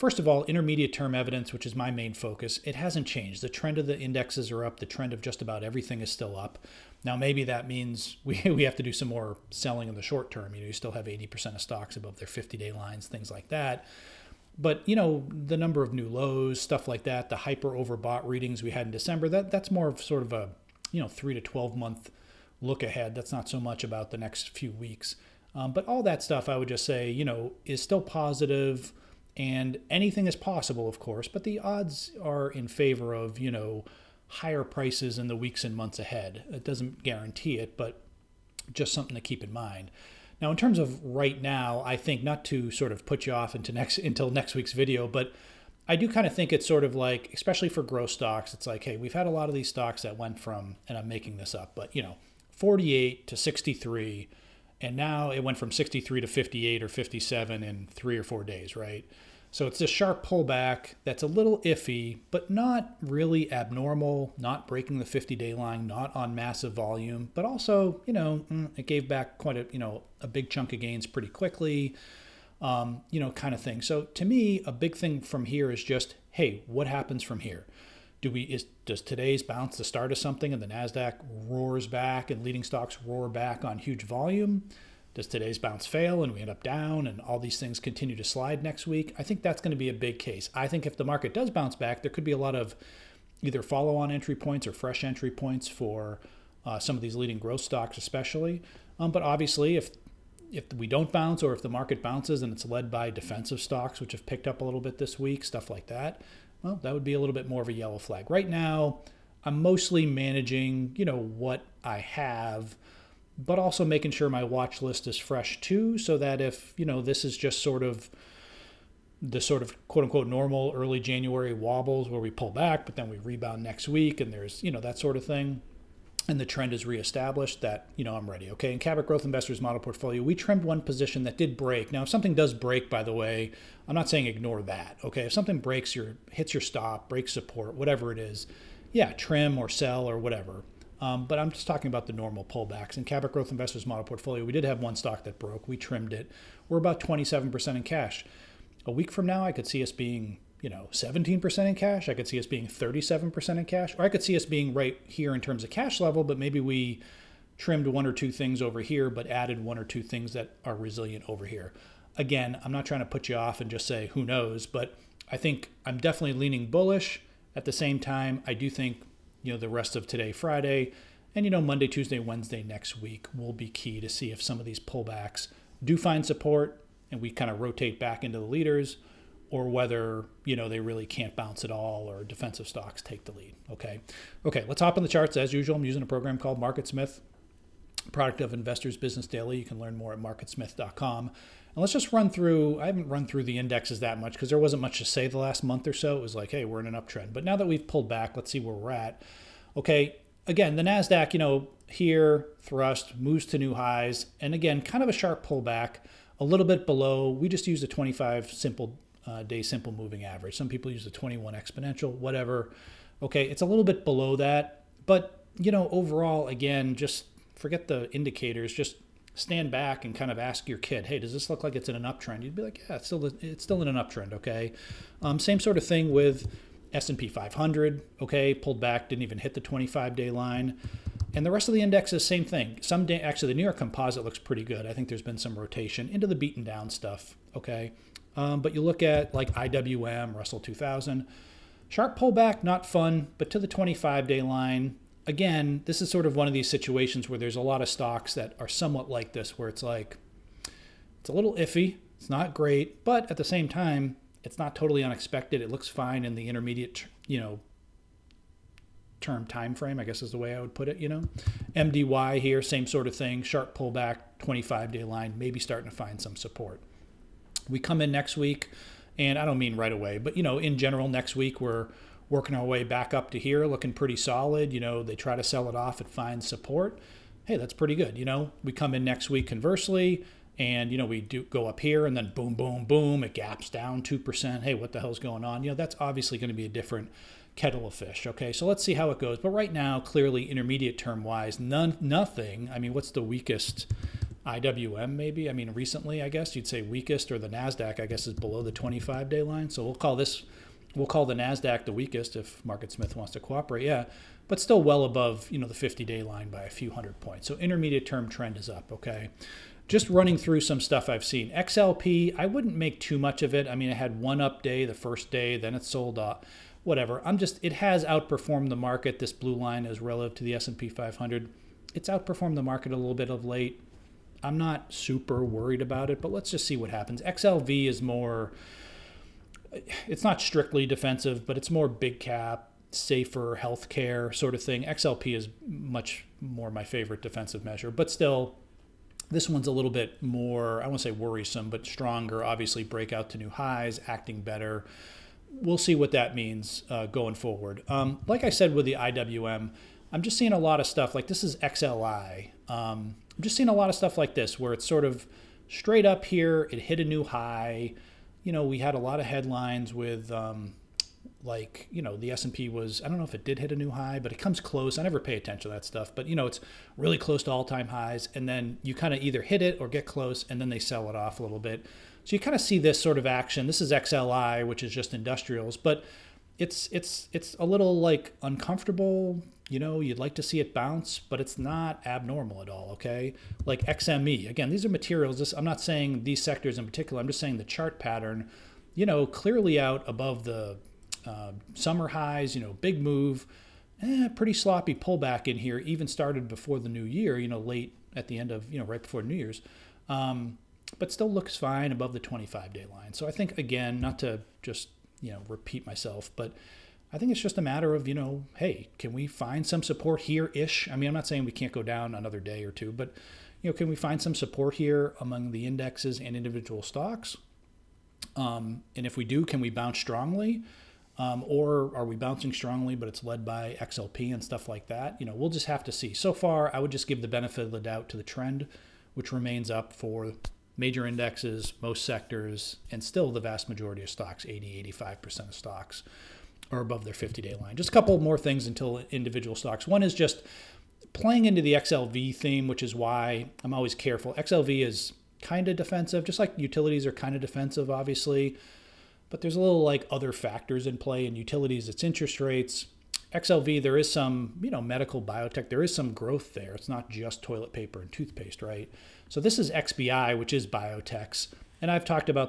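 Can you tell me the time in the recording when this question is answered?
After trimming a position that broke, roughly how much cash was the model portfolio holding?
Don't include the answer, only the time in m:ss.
2:26.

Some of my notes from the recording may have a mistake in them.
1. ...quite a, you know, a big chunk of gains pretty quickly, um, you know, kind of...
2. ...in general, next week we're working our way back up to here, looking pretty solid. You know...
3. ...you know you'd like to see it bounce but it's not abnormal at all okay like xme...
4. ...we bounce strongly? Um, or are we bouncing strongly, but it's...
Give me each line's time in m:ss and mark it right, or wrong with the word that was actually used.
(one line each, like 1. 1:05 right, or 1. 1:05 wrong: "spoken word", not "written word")
1. 1:09 right
2. 4:30 right
3. 6:19 right
4. 6:59 right.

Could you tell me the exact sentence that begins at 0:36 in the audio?
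It doesn't guarantee it, but just something to keep in mind.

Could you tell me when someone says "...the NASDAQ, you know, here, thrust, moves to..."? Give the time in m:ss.
3:20.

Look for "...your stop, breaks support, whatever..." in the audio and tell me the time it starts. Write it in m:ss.
2:16.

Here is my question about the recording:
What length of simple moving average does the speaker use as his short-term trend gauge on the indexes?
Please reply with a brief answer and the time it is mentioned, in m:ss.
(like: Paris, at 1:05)
25-day, at 3:27.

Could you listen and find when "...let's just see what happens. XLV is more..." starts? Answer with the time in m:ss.
5:26.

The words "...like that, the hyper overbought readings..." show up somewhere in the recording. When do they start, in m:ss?
0:16.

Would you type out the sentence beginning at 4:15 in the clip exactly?
It looks fine in the intermediate, you know, term time frame, I guess is the way I would put it, you know.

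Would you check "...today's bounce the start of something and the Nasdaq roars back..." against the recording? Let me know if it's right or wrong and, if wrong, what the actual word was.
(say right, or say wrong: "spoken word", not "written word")
right.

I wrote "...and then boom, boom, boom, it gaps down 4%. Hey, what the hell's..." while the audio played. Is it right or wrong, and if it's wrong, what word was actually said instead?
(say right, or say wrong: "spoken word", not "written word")
wrong: "2", not "4".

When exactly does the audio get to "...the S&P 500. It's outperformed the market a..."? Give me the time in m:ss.
5:20.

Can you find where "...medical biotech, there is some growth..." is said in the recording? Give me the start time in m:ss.
7:34.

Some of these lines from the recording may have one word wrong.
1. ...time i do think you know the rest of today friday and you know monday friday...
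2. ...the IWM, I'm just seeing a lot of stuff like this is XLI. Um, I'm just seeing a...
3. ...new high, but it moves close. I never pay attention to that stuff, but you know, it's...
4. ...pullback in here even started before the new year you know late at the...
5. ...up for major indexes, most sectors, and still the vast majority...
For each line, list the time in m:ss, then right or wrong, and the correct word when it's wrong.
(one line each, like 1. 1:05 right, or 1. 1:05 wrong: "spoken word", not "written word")
1. 2:47 wrong: "tuesday", not "friday"
2. 5:48 right
3. 6:03 wrong: "comes", not "moves"
4. 6:34 right
5. 7:09 right.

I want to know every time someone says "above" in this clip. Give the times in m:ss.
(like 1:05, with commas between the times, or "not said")
0:11, 5:05, 6:30, 6:41, 7:16.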